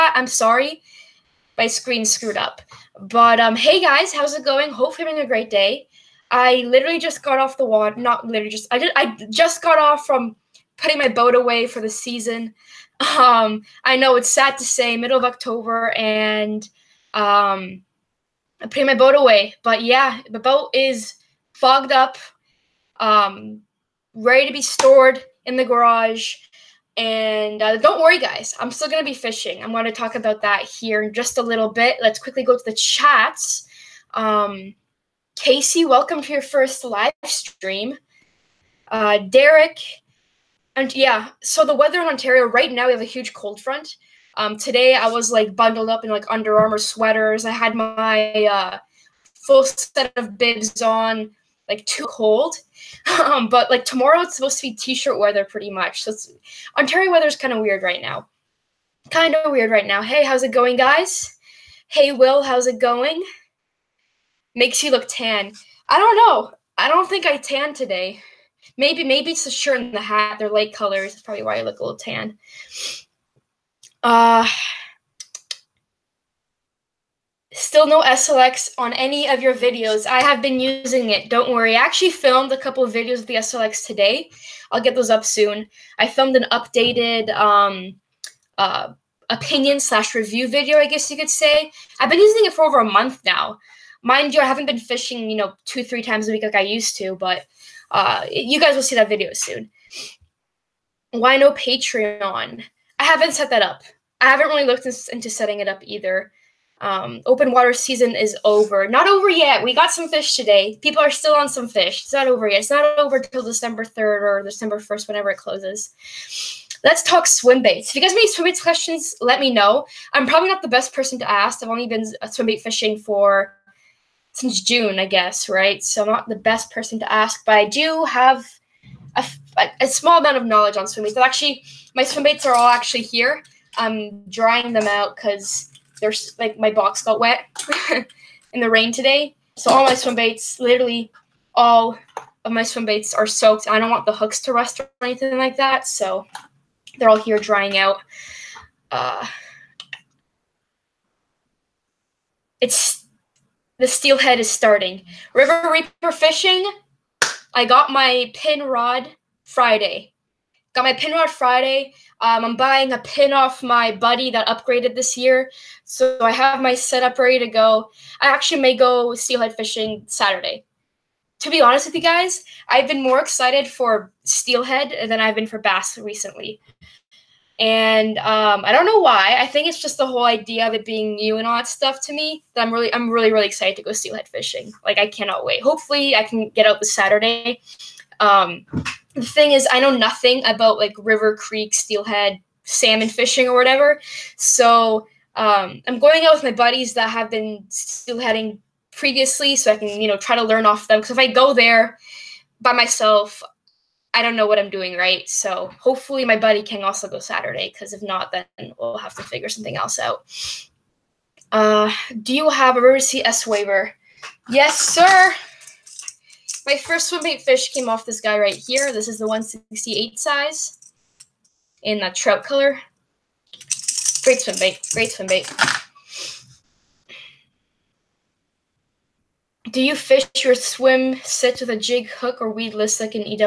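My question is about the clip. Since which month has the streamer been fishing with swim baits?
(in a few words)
June.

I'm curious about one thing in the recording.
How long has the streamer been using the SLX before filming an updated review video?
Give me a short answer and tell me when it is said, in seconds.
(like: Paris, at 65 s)
over a month, at 92 s.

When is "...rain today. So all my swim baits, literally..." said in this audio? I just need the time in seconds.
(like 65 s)
138 s.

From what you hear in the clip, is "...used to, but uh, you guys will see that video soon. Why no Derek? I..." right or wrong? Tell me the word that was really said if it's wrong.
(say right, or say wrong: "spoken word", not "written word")
wrong: "Patreon", not "Derek".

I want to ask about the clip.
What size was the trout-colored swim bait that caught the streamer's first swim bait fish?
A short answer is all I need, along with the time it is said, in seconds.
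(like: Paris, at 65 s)
168, at 219 s.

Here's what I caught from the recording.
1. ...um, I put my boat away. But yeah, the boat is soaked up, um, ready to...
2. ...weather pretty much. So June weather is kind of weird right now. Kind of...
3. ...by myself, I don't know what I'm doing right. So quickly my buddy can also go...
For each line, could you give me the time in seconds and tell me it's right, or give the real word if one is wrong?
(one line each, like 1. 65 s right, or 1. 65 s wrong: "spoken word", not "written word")
1. 17 s wrong: "fogged", not "soaked"
2. 55 s wrong: "Ontario", not "June"
3. 202 s wrong: "hopefully", not "quickly".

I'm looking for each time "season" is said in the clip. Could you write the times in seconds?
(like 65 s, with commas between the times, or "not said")
11 s, 107 s.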